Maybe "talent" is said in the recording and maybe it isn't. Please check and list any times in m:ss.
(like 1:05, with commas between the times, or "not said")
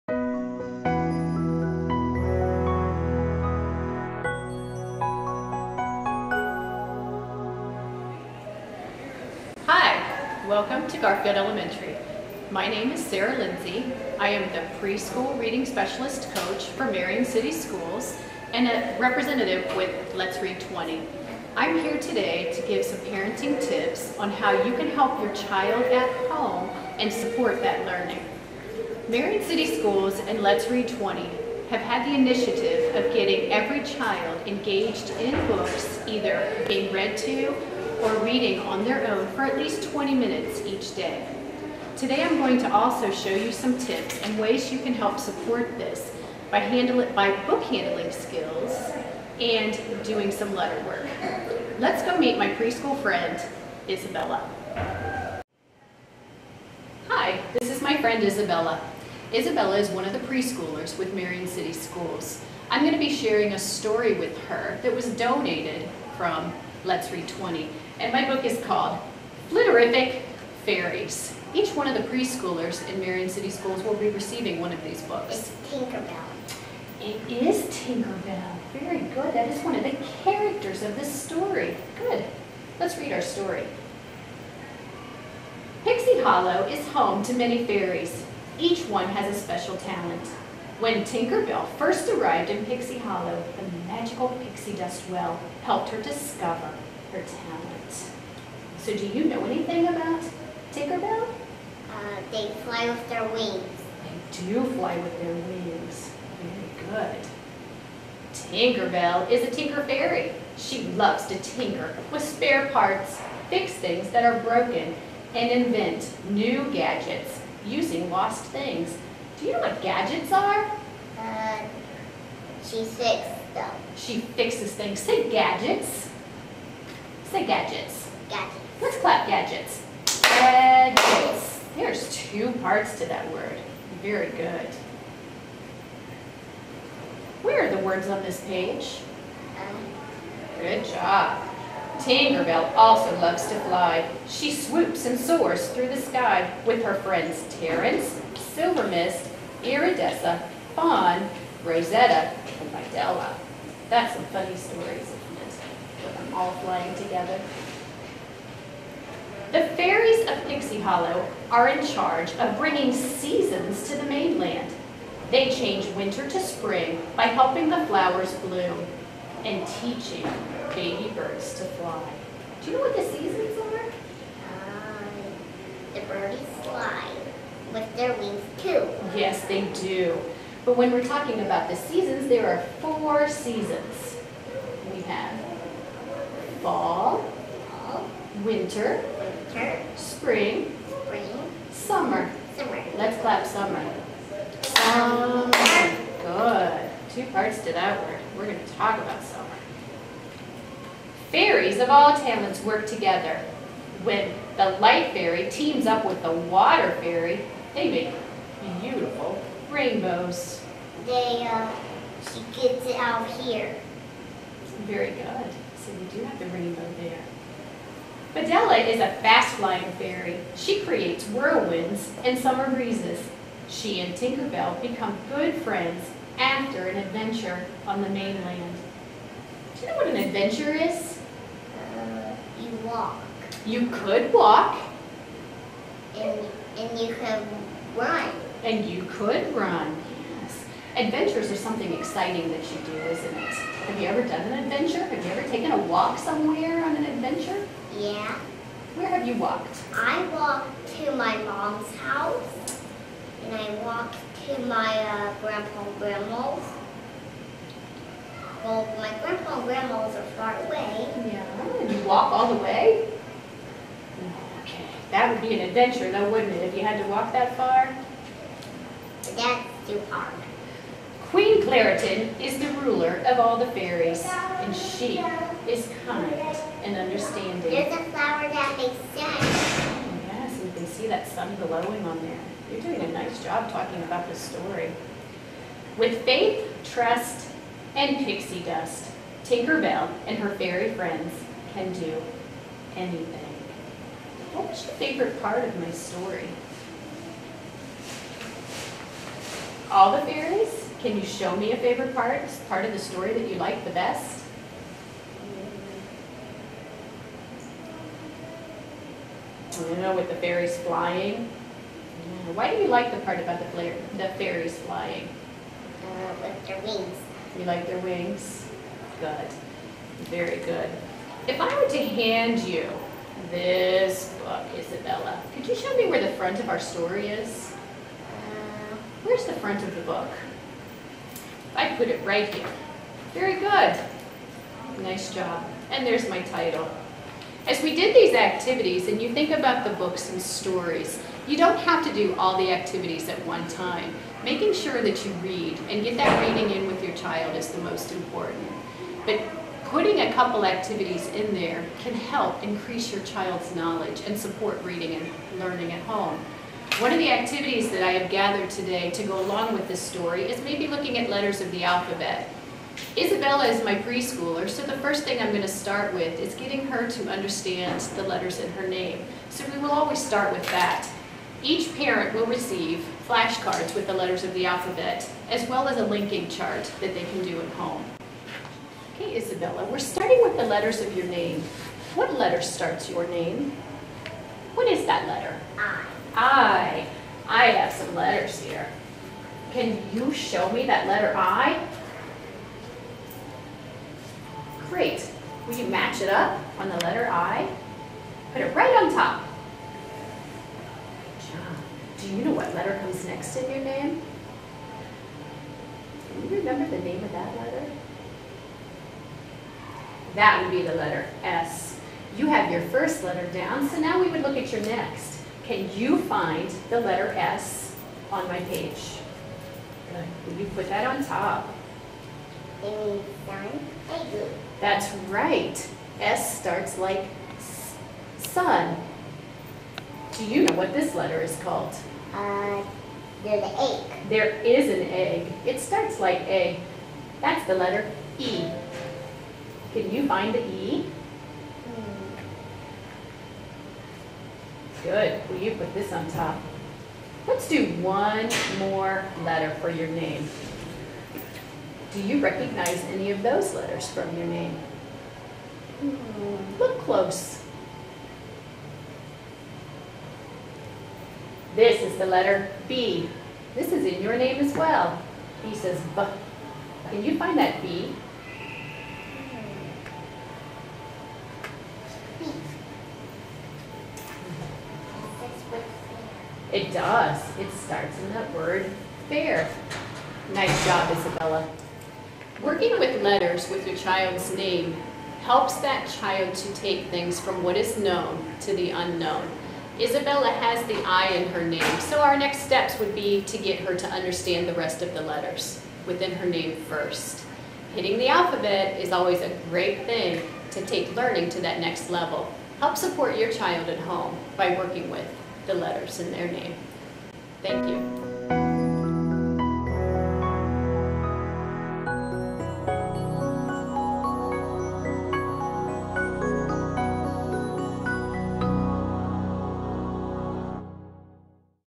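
1:29, 1:37, 3:22.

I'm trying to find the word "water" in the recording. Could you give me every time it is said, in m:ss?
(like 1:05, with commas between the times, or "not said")
3:26.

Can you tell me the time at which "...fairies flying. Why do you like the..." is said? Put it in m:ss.
5:10.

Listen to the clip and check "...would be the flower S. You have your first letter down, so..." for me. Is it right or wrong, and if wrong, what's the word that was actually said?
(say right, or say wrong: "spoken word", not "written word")
wrong: "letter", not "flower".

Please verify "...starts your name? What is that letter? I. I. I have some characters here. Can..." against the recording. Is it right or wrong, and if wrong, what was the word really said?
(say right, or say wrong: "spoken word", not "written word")
wrong: "letters", not "characters".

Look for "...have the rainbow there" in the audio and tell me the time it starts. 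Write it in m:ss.
3:36.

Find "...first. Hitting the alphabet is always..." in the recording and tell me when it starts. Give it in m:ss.
8:16.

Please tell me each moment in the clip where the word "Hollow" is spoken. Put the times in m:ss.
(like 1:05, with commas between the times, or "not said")
1:26, 1:32, 2:40.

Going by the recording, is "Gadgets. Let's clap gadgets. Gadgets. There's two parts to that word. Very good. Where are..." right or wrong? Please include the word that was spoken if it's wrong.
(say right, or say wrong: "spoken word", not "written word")
right.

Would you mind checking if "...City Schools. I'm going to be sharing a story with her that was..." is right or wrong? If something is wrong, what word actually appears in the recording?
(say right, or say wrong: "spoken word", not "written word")
right.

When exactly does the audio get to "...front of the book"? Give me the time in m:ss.
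5:29.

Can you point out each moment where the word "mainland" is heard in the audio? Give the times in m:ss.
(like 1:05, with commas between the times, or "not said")
2:44, 3:48.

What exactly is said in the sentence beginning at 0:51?
Let's go meet my preschool friend, Isabella.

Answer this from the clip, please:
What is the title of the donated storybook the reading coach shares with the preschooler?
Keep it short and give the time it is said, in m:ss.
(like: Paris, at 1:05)
Flitterific Fairies, at 1:09.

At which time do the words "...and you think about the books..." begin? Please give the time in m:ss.
5:39.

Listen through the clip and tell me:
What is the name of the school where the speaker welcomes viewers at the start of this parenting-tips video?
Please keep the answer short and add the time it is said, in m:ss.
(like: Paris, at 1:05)
Garfield Elementary, at 0:10.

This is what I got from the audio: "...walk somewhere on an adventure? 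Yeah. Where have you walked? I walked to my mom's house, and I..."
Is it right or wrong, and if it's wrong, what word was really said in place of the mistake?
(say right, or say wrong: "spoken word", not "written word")
right.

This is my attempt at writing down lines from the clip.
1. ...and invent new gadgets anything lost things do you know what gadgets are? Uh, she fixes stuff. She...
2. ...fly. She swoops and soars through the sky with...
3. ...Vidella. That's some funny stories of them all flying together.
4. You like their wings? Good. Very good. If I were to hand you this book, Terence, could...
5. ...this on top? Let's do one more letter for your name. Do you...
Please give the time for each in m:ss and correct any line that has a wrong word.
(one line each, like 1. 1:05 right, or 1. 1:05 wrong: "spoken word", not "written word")
1. 1:55 wrong: "using", not "anything"
2. 2:23 right
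3. 2:32 right
4. 5:17 wrong: "Isabella", not "Terence"
5. 7:25 right.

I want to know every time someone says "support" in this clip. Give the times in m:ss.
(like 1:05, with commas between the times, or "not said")
0:27, 0:45, 5:54, 8:22.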